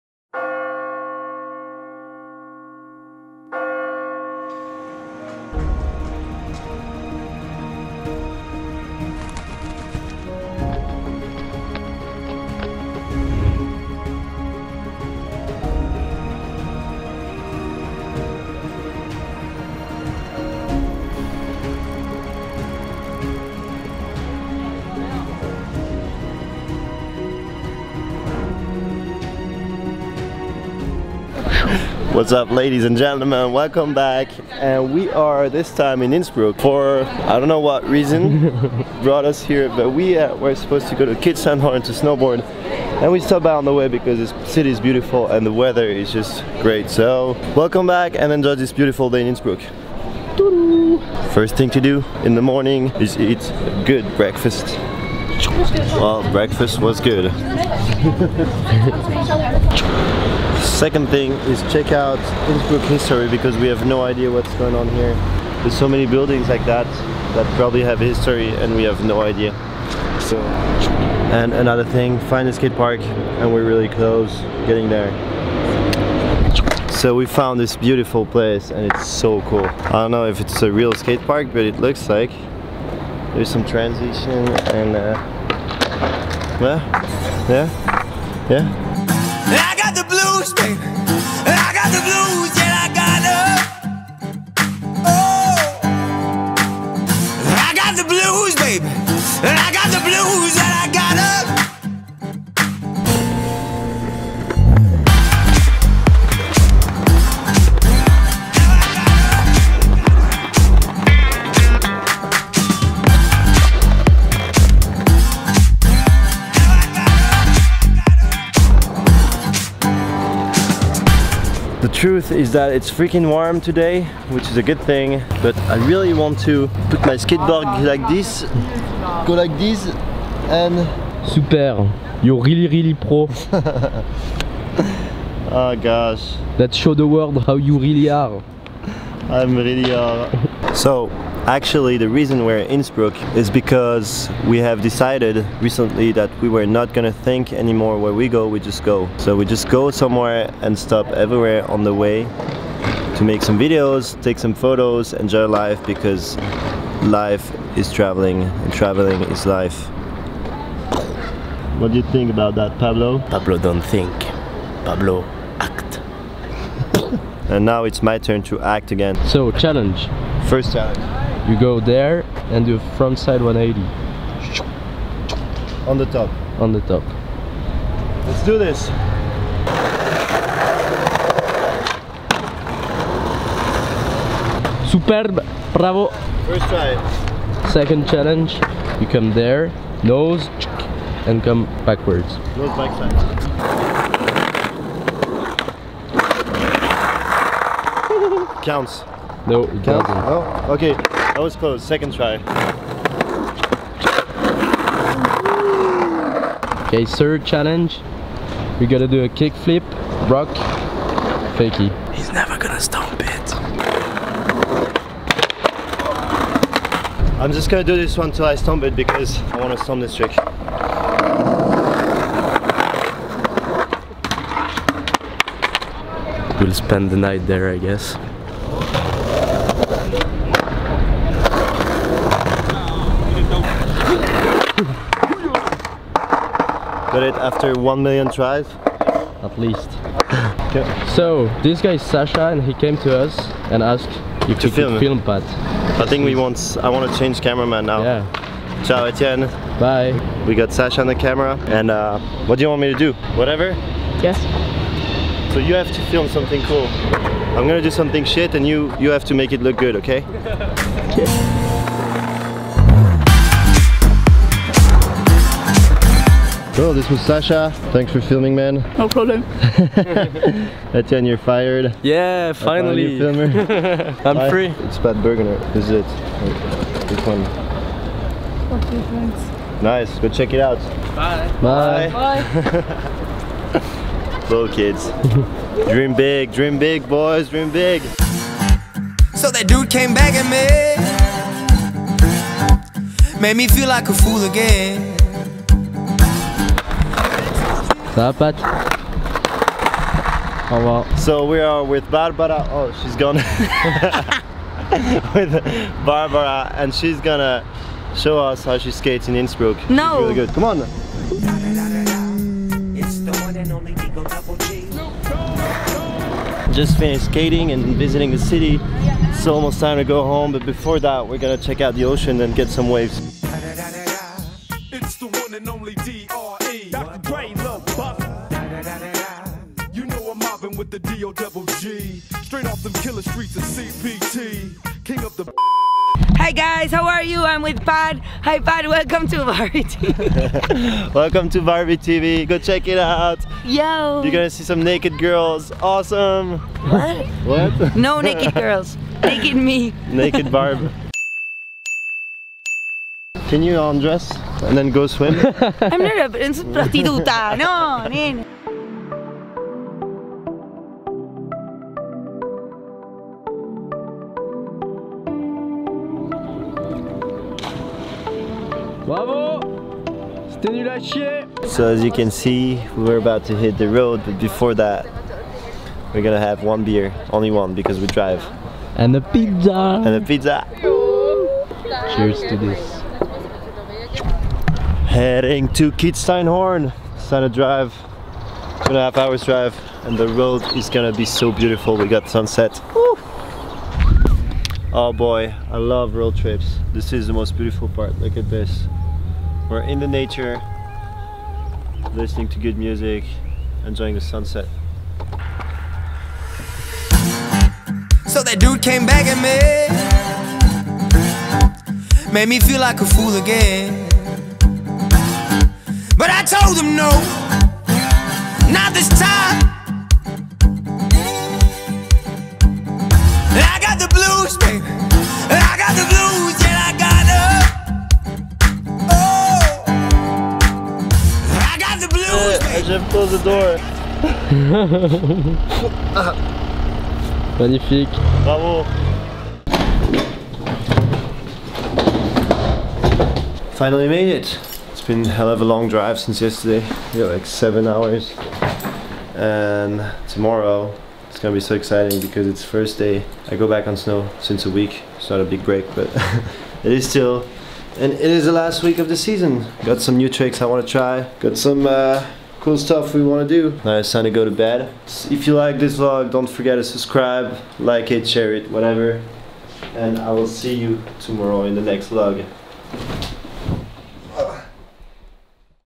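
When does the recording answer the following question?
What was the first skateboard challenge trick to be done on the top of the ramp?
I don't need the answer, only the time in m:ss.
2:52.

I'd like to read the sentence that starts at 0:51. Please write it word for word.
First thing to do in the morning is eat a good breakfast.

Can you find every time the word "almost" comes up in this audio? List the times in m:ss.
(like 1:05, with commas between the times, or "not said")
5:19.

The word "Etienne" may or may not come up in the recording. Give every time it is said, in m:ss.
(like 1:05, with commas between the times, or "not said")
4:09, 4:30.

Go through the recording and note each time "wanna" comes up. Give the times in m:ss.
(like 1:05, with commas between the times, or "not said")
3:39.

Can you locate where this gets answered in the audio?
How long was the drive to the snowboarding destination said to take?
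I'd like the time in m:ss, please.
6:28.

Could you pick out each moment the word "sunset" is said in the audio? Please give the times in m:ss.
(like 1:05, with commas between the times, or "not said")
6:32, 6:44.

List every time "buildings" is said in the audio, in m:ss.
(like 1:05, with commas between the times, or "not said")
1:06.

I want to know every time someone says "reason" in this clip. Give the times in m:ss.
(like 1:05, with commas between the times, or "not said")
0:37, 2:22.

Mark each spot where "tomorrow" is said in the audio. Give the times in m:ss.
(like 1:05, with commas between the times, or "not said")
7:30, 7:51.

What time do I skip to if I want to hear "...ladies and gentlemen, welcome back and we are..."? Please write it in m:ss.
0:32.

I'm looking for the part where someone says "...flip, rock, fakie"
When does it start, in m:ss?
3:29.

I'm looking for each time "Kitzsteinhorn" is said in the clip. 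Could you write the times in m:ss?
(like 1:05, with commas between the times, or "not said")
0:41, 6:25.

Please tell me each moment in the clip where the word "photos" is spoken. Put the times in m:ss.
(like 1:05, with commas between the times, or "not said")
2:34.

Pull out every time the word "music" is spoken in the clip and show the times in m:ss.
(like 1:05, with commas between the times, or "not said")
6:42.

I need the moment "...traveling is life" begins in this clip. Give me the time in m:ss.
2:38.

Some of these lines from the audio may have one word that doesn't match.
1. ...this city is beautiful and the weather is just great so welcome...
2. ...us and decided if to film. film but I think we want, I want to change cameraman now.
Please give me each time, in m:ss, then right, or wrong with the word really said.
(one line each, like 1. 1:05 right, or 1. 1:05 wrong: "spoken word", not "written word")
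1. 0:44 right
2. 4:03 wrong: "asked", not "decided".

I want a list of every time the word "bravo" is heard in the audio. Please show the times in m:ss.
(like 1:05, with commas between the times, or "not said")
3:05, 7:18.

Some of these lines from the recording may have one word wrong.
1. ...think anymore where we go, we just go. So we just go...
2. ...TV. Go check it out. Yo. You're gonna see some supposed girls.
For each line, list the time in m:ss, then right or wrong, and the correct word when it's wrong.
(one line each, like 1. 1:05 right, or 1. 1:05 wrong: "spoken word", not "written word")
1. 2:27 right
2. 5:41 wrong: "naked", not "supposed".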